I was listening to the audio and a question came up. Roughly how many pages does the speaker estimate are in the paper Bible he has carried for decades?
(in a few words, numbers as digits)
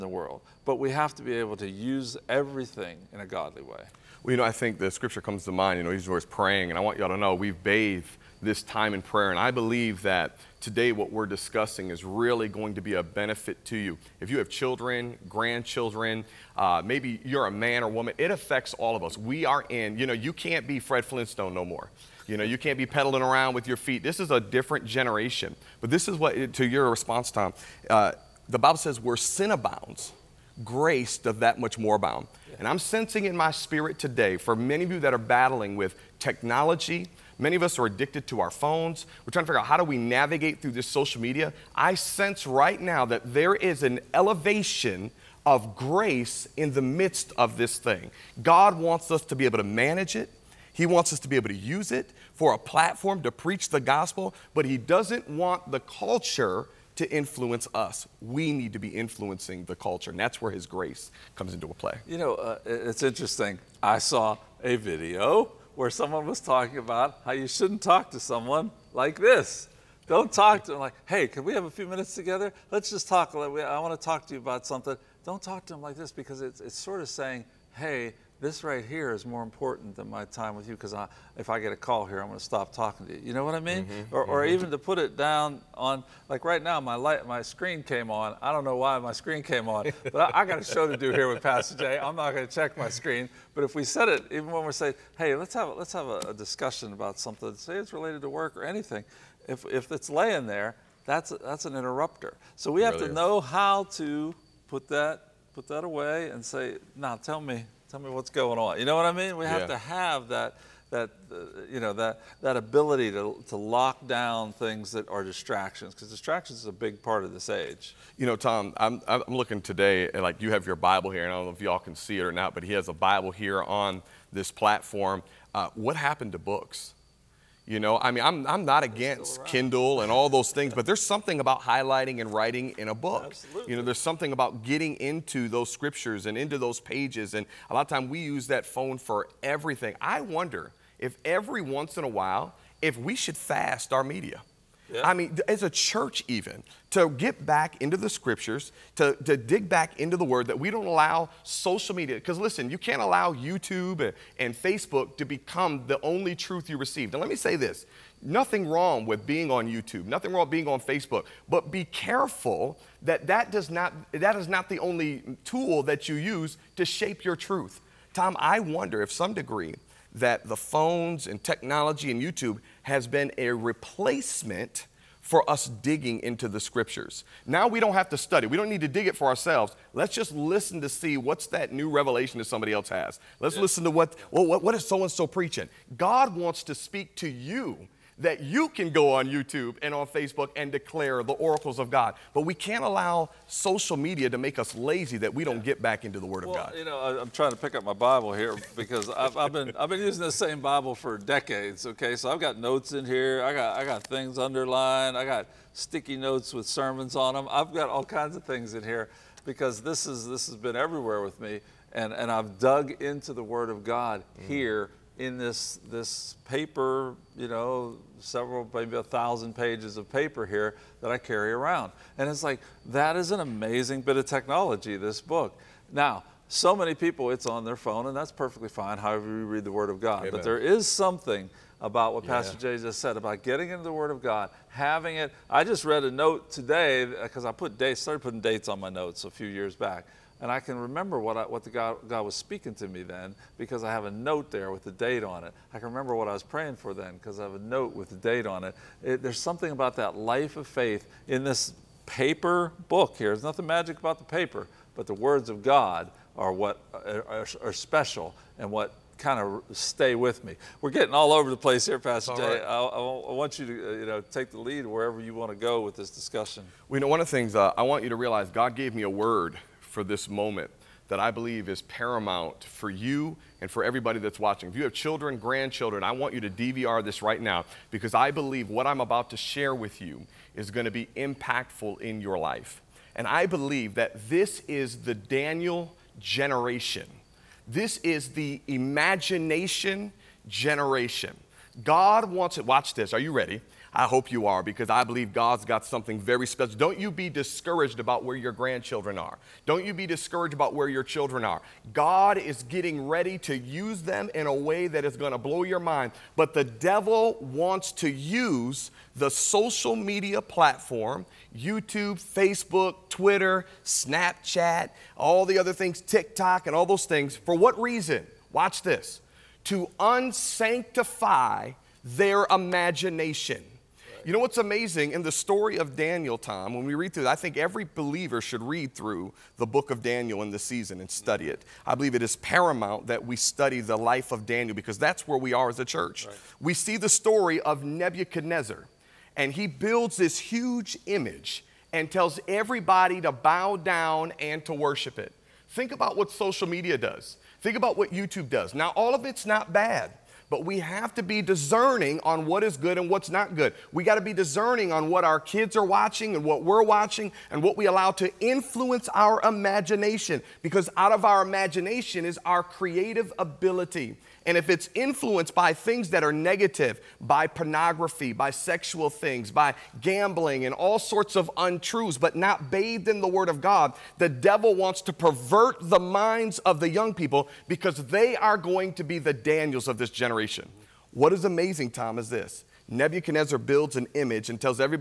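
1000.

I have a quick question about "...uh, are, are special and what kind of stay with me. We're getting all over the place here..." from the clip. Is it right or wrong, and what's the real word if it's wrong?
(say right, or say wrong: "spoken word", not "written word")
right.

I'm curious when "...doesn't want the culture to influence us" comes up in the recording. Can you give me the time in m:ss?
0:54.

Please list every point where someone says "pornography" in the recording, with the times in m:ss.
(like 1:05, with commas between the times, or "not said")
6:07.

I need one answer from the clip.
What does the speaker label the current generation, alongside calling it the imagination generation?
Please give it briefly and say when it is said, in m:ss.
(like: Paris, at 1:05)
the Daniel generation, at 4:45.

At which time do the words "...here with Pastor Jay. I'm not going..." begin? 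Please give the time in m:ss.
1:31.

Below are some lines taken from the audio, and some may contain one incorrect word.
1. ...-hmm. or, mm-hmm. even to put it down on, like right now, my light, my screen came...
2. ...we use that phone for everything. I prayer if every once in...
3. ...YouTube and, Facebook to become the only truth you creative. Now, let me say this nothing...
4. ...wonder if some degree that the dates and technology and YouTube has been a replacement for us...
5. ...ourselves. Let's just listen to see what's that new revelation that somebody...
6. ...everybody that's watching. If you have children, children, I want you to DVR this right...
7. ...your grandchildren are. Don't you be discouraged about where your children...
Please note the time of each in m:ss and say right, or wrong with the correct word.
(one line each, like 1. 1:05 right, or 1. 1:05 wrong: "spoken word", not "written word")
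1. 1:24 right
2. 2:18 wrong: "wonder", not "prayer"
3. 2:33 wrong: "receive", not "creative"
4. 2:48 wrong: "phones", not "dates"
5. 2:59 right
6. 4:33 wrong: "grandchildren", not "children"
7. 4:58 right.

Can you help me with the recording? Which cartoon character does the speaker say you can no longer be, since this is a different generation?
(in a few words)
Fred Flintstone.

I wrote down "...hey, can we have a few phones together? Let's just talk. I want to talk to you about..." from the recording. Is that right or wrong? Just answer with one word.
wrong.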